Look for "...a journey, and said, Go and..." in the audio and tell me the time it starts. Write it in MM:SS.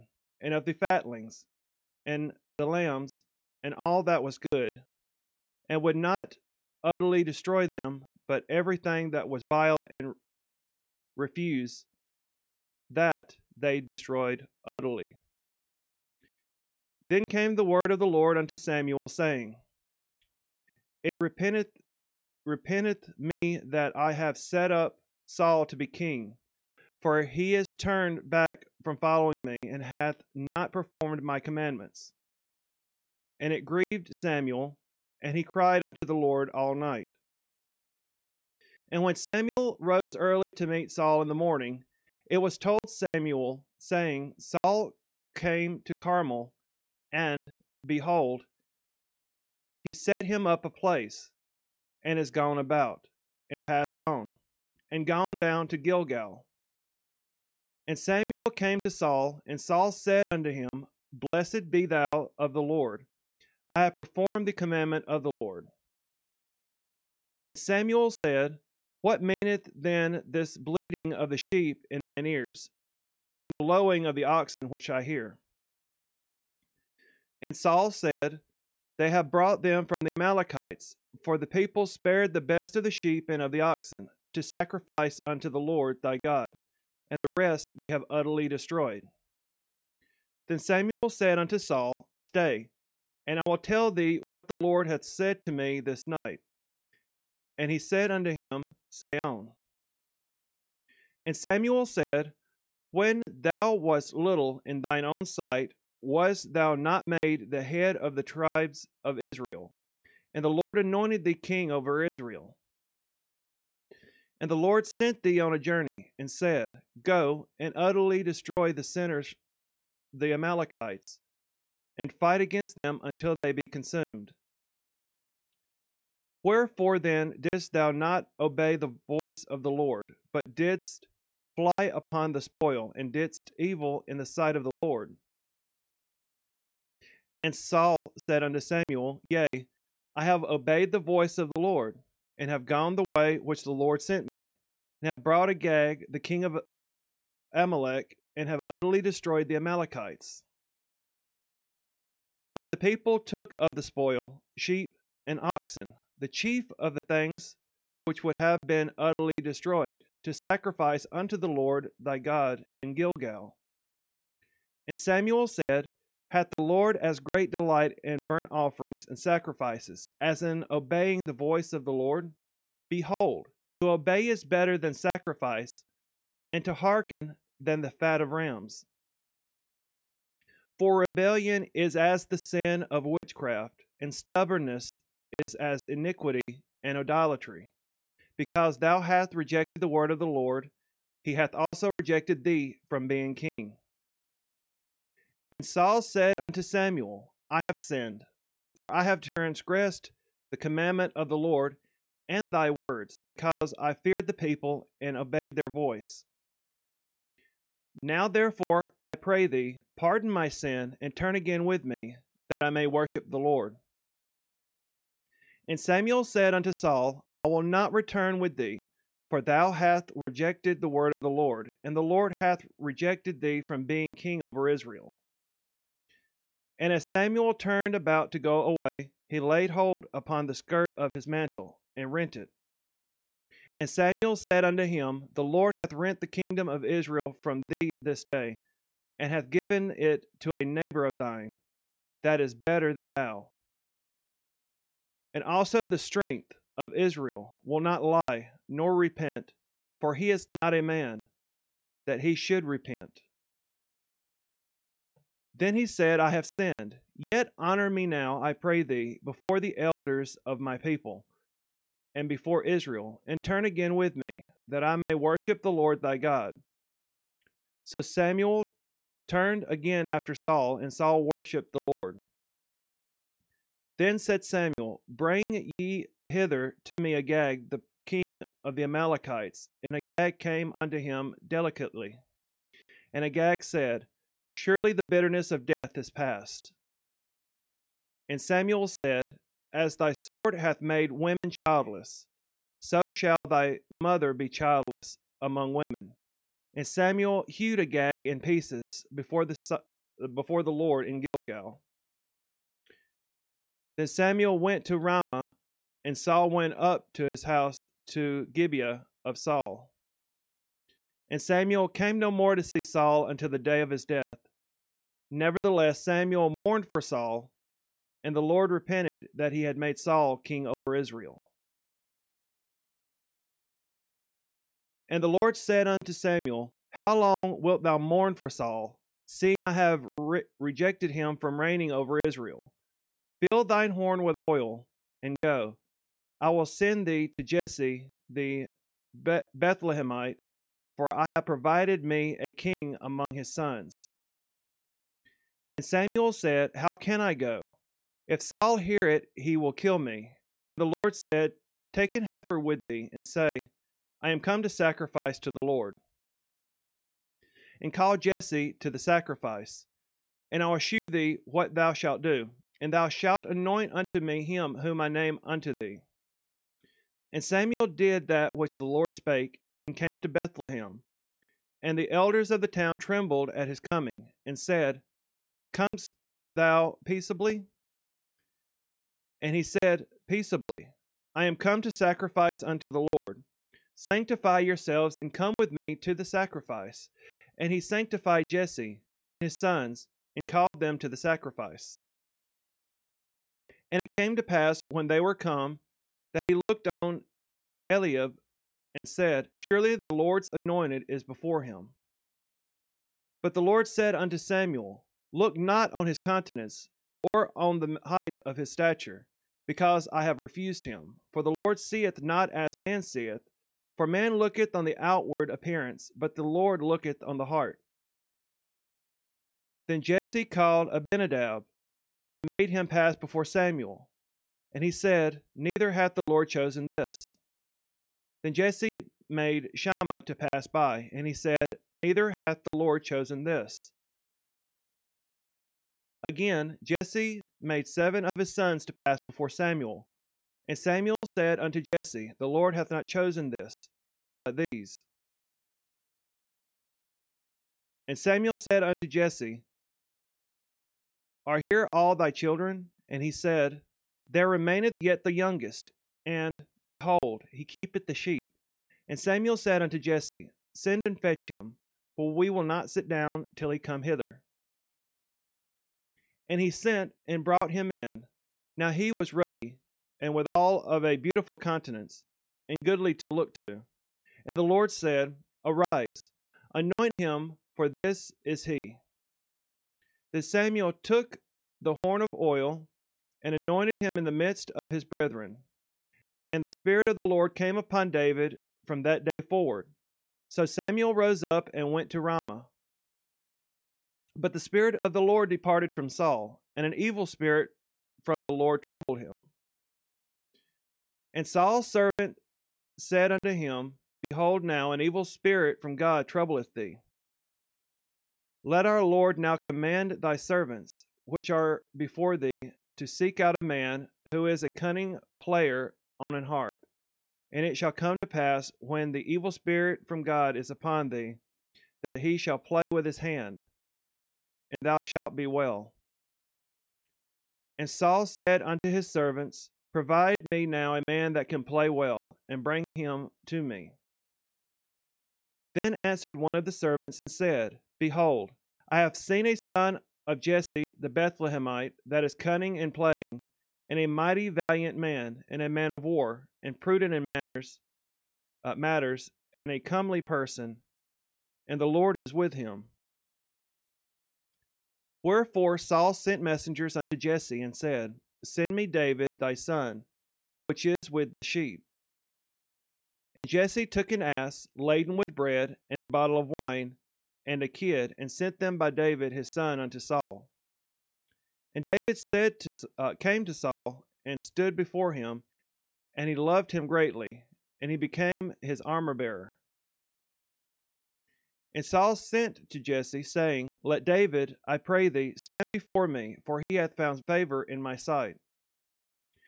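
01:55.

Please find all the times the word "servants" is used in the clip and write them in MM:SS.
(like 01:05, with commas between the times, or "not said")
08:21, 08:30, 08:49, 08:56.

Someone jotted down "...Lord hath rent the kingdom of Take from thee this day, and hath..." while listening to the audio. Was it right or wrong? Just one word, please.
wrong.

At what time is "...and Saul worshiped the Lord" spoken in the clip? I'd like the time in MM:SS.
04:30.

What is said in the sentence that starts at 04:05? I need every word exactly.
And also the strength of Israel will not lie nor repent, for he is not a man that he should repent.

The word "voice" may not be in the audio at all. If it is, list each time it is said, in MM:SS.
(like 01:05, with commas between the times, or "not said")
02:09, 02:20, 02:51, 03:25.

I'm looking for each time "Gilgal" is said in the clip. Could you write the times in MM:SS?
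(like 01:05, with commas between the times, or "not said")
00:55, 02:42, 05:01.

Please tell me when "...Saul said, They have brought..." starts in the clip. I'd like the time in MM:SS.
01:17.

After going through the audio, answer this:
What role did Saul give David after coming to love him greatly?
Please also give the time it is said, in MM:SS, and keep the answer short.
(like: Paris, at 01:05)
Armor bearer, at 09:38.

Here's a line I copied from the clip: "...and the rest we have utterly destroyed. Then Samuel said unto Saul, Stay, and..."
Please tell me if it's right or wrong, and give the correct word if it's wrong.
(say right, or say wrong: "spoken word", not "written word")
right.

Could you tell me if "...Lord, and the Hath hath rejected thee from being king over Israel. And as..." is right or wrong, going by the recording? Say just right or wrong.
wrong.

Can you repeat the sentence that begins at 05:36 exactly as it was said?
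I will send thee to Jesse the Bethlehemite, for I have provided me a king among his sons.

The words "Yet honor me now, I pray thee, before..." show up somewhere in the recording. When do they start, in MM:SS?
04:17.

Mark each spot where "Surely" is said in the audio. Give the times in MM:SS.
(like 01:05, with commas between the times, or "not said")
04:44, 06:39.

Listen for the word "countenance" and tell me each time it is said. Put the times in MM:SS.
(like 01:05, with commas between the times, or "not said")
06:46, 07:51.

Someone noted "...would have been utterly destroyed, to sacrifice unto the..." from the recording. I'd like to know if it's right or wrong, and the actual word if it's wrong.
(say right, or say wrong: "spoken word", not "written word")
right.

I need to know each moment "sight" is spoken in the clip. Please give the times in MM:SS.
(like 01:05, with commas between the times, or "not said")
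01:45, 02:14, 09:47.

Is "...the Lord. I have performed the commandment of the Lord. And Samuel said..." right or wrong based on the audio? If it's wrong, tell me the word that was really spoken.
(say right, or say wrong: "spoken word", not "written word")
right.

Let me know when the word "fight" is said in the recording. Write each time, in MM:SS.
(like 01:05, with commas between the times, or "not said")
02:02.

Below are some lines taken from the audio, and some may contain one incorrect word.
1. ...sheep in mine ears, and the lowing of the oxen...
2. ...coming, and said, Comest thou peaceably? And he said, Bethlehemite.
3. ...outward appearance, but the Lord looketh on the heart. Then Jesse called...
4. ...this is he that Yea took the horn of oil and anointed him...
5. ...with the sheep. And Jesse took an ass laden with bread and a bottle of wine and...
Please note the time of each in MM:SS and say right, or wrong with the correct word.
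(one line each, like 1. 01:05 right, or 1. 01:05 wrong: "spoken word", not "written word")
1. 01:11 right
2. 06:13 wrong: "Peaceably", not "Bethlehemite"
3. 06:54 right
4. 07:57 wrong: "Samuel", not "Yea"
5. 09:21 right.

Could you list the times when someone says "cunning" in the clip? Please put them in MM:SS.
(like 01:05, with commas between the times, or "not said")
08:34, 09:02.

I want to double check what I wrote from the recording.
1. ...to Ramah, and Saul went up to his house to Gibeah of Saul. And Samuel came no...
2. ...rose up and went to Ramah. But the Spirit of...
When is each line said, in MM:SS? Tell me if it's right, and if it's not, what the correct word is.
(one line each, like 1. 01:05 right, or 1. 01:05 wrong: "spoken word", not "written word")
1. 05:04 right
2. 08:11 right.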